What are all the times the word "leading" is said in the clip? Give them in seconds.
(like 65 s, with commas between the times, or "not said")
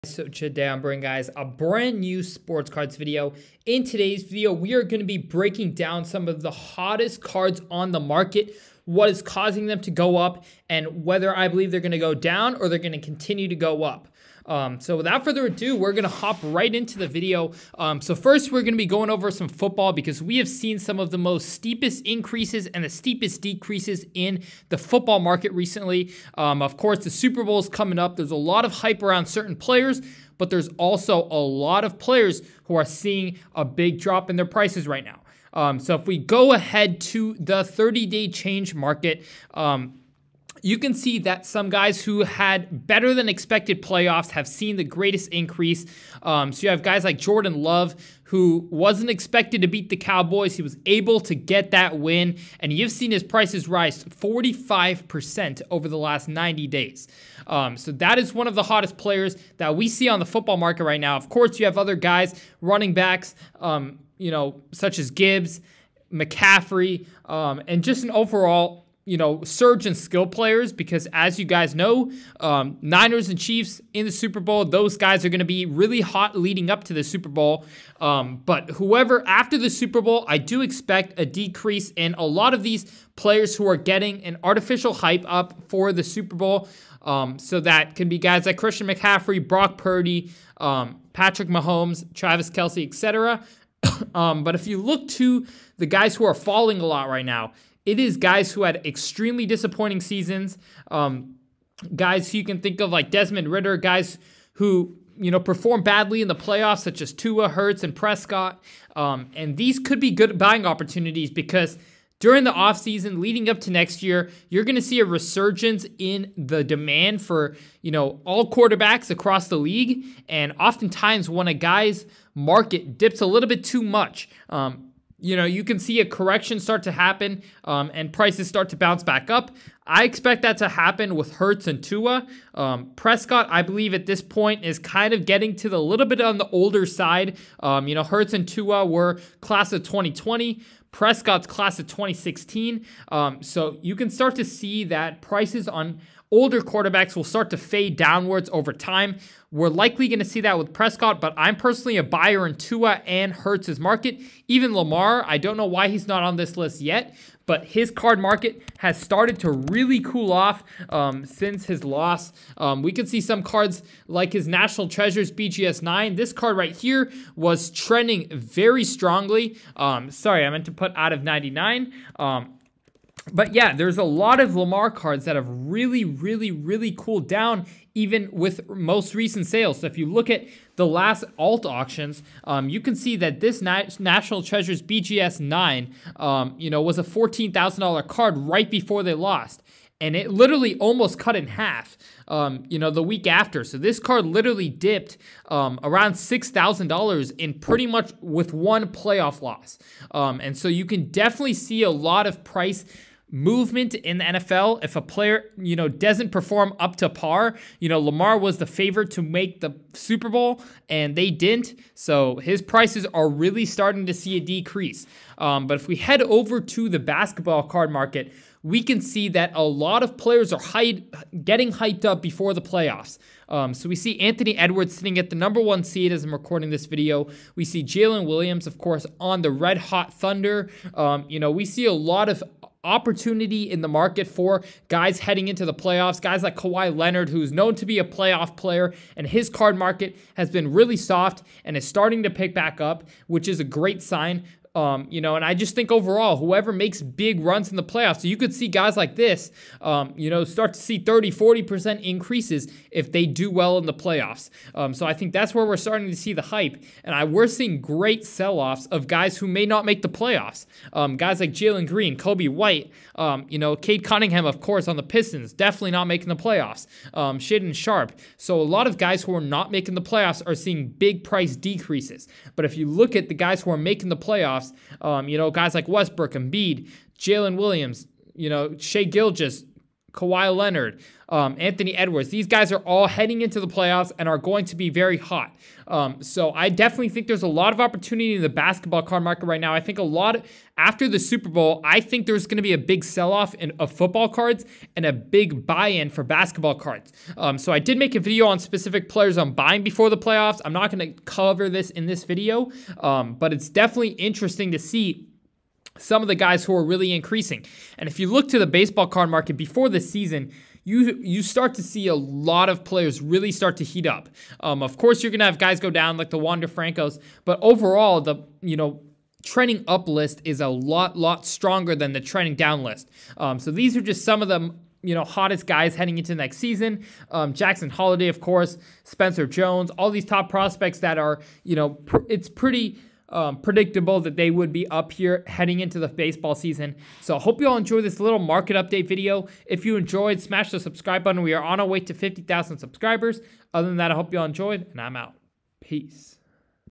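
76 s, 113 s.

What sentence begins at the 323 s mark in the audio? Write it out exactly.
Um, so these are just some of the you know hottest guys heading into next season.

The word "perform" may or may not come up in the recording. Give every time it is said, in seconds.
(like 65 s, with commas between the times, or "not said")
105 s, 206 s.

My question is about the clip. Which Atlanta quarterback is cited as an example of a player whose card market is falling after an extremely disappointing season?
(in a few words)
Desmond Ridder.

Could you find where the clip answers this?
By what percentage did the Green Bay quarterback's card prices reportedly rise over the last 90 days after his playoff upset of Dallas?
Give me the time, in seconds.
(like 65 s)
54 s.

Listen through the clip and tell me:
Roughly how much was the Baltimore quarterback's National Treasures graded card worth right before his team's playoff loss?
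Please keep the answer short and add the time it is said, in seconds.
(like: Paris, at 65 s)
$14,000, at 187 s.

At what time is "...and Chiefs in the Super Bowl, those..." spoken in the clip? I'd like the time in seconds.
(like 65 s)
73 s.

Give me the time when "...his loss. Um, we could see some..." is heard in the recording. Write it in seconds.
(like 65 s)
161 s.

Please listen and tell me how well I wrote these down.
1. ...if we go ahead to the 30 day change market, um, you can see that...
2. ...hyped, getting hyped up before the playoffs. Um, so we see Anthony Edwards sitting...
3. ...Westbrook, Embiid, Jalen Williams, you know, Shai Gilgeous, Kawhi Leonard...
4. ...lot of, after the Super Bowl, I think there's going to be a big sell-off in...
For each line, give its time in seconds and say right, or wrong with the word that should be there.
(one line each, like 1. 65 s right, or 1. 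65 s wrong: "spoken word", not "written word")
1. 35 s right
2. 220 s right
3. 275 s right
4. 290 s right.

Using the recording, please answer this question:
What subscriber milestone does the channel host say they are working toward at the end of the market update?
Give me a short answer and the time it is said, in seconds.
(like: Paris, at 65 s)
50,000, at 342 s.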